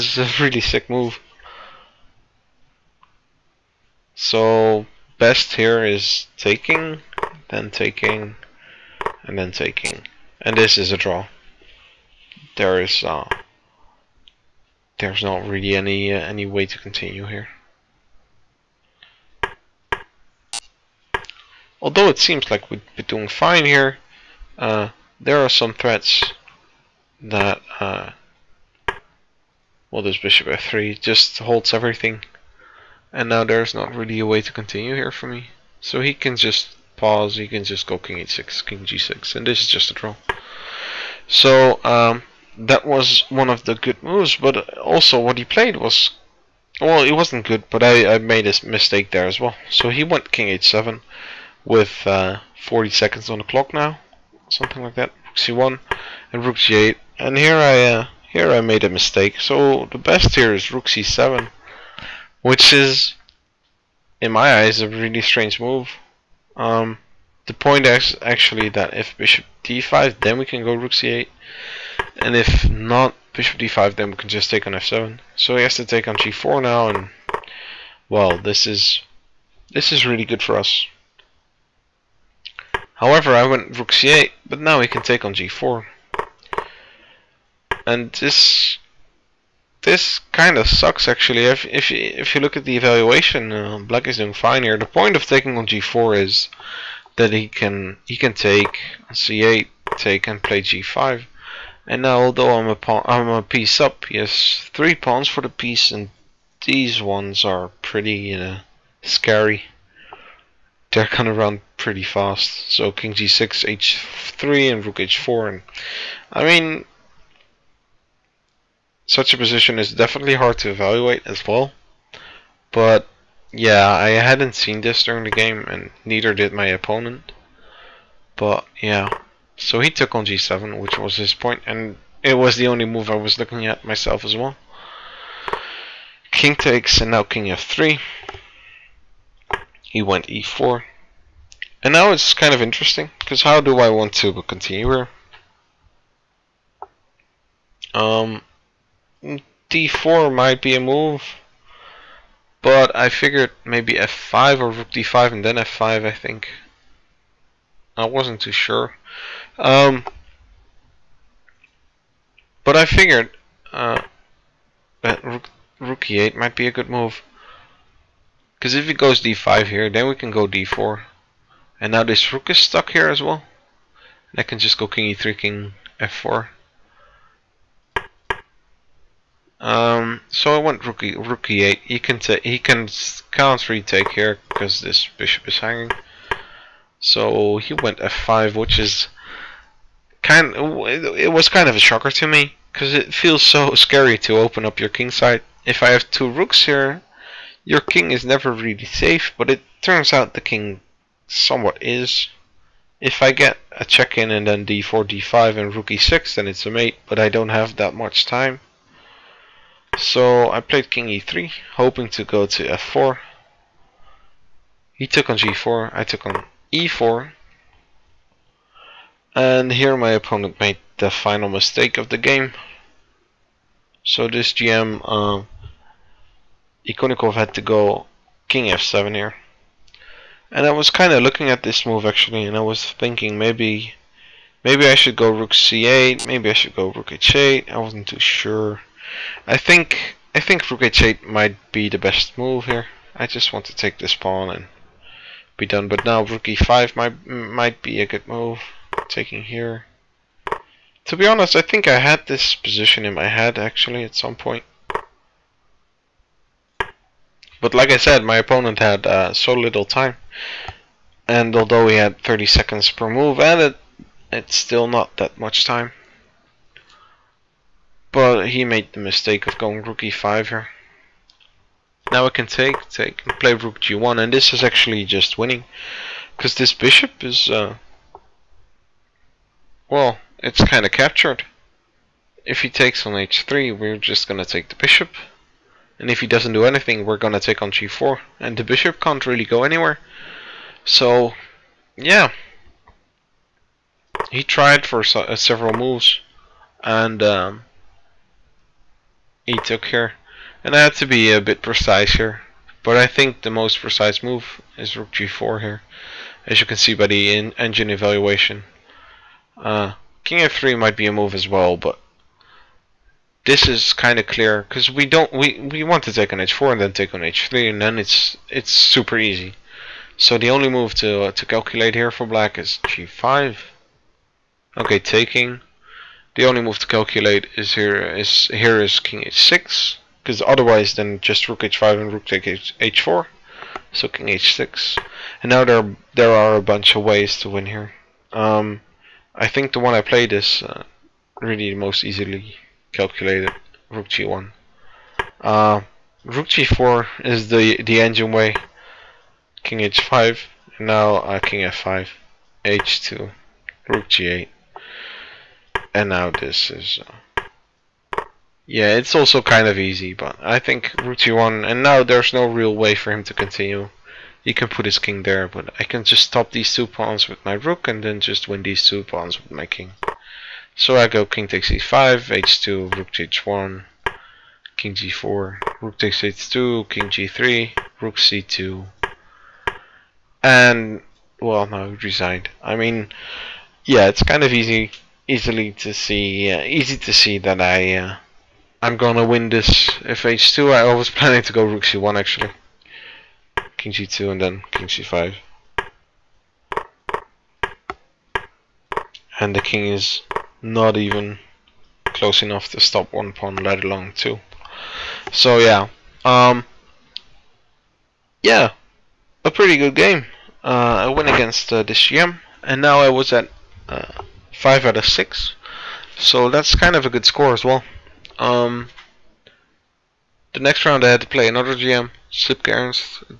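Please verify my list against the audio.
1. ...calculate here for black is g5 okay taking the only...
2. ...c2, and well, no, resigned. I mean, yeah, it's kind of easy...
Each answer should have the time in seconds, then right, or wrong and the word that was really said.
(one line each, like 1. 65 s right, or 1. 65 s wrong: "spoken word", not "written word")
1. 321 s right
2. 378 s right.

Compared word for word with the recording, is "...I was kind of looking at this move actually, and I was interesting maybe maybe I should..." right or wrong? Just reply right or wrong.
wrong.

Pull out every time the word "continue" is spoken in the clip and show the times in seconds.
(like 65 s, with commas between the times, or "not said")
16 s, 34 s, 144 s, 363 s.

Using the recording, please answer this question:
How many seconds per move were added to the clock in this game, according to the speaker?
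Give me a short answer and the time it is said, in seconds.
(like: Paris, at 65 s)
30, at 262 s.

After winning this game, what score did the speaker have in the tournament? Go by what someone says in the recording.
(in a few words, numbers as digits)
5 out of 6.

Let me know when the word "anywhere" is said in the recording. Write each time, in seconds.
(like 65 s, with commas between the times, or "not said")
289 s.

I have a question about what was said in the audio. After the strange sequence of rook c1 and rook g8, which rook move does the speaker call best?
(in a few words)
rook c7.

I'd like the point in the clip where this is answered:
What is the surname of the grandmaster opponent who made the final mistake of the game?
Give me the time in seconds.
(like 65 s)
226 s.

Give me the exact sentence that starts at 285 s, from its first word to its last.
And if he doesn't do anything, we're gonna take on g4.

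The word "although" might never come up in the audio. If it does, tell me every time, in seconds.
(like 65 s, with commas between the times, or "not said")
21 s, 102 s, 261 s.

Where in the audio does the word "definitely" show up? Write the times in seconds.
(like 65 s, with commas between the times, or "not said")
119 s.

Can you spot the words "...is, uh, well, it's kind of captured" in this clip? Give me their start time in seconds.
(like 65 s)
277 s.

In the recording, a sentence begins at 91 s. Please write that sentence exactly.
If if you, if you look at the evaluation, uh, black is doing fine here.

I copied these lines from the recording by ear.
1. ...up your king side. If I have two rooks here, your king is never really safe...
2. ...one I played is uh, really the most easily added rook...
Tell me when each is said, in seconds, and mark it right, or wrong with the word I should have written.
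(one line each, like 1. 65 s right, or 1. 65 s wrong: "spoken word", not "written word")
1. 194 s right
2. 339 s wrong: "calculated", not "added".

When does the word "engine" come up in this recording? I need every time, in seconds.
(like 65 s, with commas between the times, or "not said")
307 s, 347 s.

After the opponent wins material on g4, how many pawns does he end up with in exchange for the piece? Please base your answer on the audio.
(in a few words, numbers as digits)
three.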